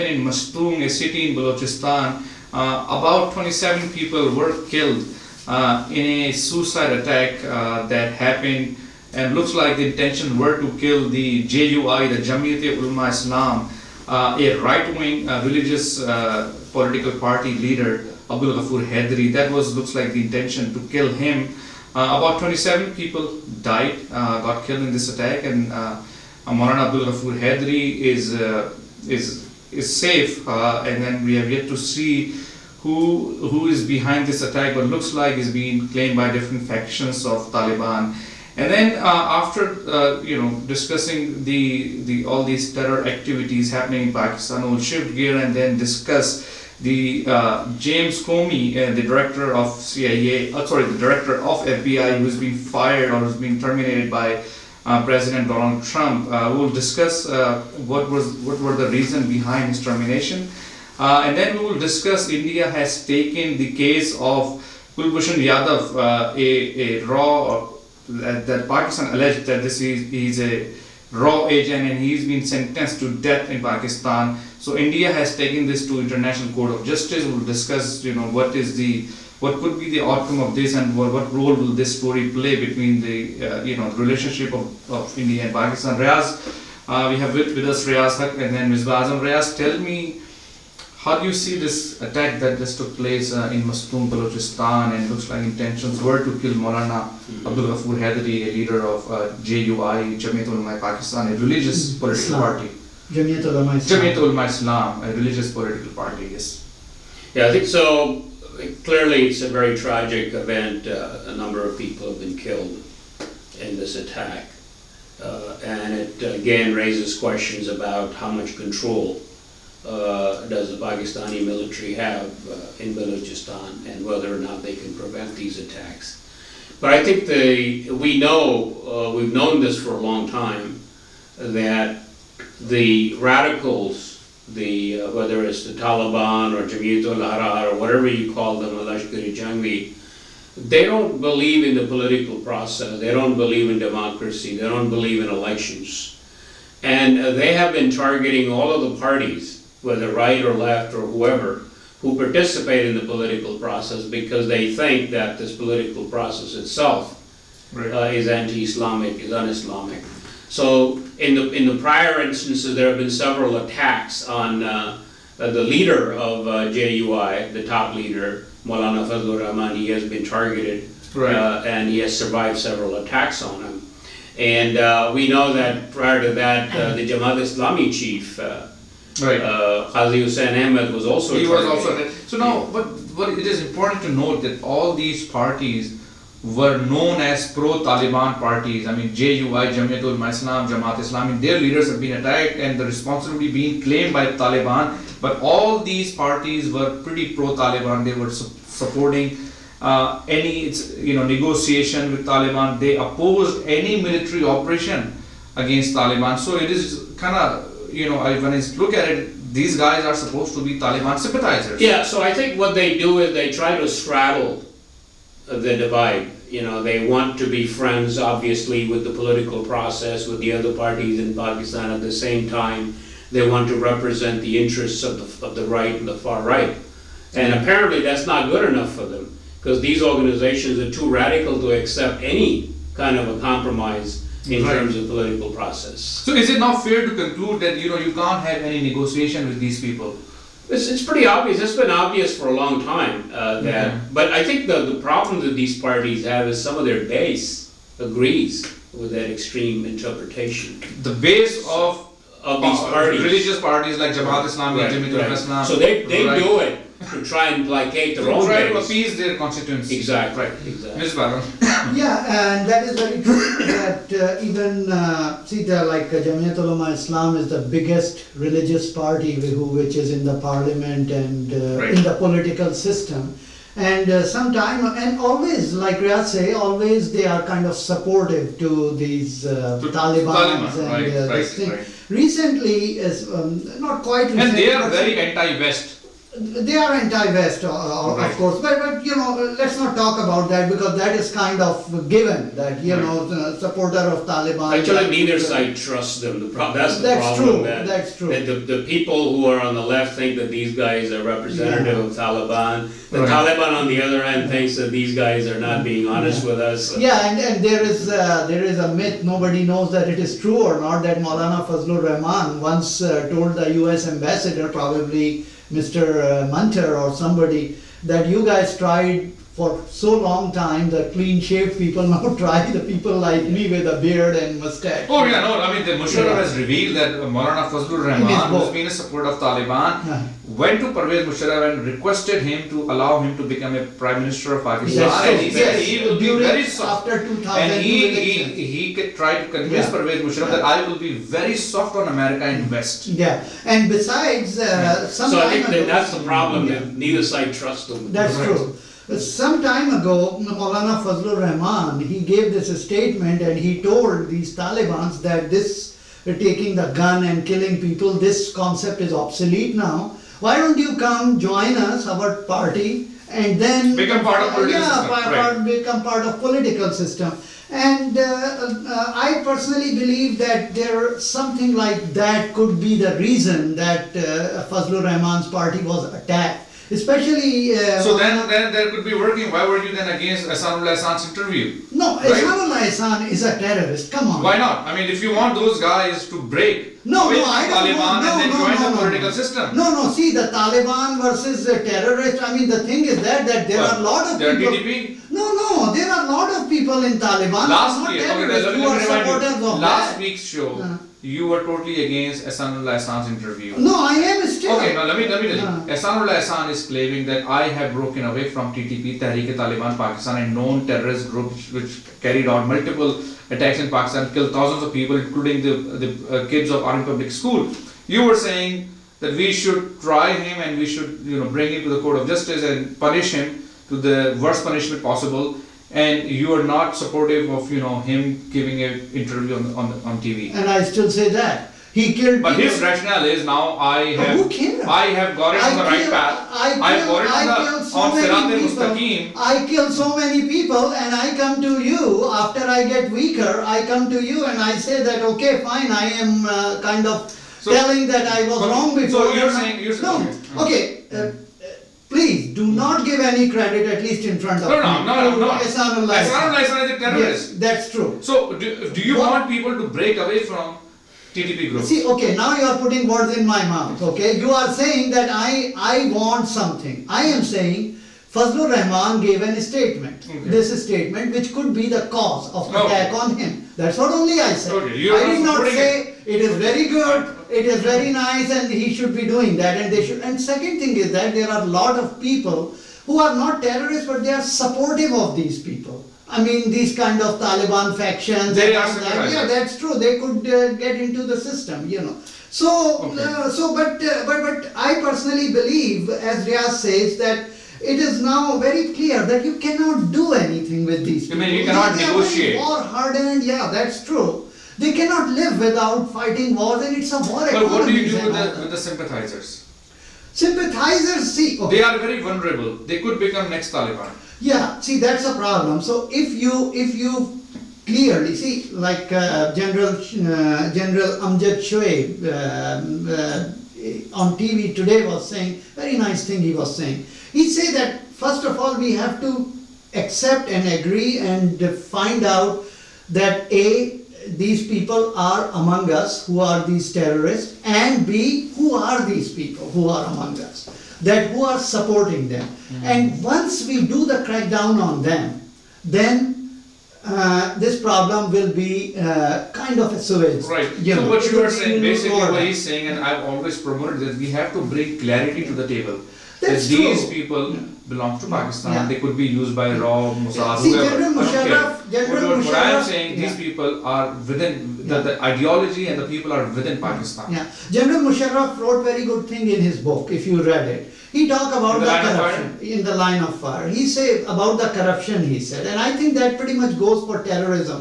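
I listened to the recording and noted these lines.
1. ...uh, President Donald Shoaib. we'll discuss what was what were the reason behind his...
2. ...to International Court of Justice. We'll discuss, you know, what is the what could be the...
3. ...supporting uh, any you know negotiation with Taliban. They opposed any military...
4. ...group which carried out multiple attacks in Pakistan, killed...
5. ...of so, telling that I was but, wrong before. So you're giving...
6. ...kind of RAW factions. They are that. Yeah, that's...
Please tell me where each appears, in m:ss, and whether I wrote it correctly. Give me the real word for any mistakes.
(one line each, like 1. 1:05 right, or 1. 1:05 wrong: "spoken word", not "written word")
1. 0:54 wrong: "Trump", not "Shoaib"
2. 1:15 right
3. 3:18 right
4. 6:51 right
5. 7:27 wrong: "saying", not "giving"
6. 8:06 wrong: "Taliban", not "RAW".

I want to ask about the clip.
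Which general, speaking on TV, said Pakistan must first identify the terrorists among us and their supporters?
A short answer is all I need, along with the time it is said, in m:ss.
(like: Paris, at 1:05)
Amjad Shoaib, at 8:40.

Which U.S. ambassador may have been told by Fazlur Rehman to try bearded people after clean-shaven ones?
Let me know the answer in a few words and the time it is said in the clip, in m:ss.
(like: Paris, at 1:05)
Munter, at 5:16.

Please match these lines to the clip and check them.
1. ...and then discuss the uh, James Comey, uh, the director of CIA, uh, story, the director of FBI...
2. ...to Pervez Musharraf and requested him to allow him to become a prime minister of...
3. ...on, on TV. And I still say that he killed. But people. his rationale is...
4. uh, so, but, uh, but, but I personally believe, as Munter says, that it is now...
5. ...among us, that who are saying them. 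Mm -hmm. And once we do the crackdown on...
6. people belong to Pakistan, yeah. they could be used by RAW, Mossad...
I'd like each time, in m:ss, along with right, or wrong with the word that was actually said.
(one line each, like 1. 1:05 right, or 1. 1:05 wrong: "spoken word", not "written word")
1. 0:45 wrong: "sorry", not "story"
2. 5:30 right
3. 7:09 right
4. 8:13 wrong: "Riaz", not "Munter"
5. 9:00 wrong: "supporting", not "saying"
6. 9:17 right.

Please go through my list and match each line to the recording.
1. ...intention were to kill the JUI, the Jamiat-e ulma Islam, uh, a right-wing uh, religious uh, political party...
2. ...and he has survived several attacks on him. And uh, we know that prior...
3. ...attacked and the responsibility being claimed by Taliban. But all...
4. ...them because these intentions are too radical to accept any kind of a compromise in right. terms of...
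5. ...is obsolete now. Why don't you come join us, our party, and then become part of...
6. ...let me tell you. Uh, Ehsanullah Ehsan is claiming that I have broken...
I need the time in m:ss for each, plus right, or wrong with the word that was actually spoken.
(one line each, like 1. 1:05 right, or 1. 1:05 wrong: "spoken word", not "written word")
1. 0:09 right
2. 2:51 right
3. 3:12 right
4. 3:49 wrong: "organizations", not "intentions"
5. 5:58 right
6. 6:45 right.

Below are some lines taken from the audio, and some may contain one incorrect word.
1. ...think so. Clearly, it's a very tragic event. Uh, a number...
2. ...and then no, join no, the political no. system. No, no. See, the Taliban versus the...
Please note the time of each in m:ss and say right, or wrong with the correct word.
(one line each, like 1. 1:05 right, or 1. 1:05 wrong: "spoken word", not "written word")
1. 1:47 right
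2. 6:28 right.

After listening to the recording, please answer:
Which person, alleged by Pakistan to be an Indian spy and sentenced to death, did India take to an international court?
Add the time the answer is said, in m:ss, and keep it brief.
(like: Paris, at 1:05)
Kulbhushan Yadav, at 1:04.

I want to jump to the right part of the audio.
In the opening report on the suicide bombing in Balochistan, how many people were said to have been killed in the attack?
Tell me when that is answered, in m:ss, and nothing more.
0:02.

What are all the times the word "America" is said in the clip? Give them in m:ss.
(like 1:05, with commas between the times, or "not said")
5:42.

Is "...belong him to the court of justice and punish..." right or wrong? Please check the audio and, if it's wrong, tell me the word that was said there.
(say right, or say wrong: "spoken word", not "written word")
wrong: "bring", not "belong".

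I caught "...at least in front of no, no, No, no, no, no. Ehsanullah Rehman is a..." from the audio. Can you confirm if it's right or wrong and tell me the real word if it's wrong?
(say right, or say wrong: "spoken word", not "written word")
wrong: "Ehsan", not "Rehman".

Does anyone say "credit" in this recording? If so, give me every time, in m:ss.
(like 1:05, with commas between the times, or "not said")
7:33.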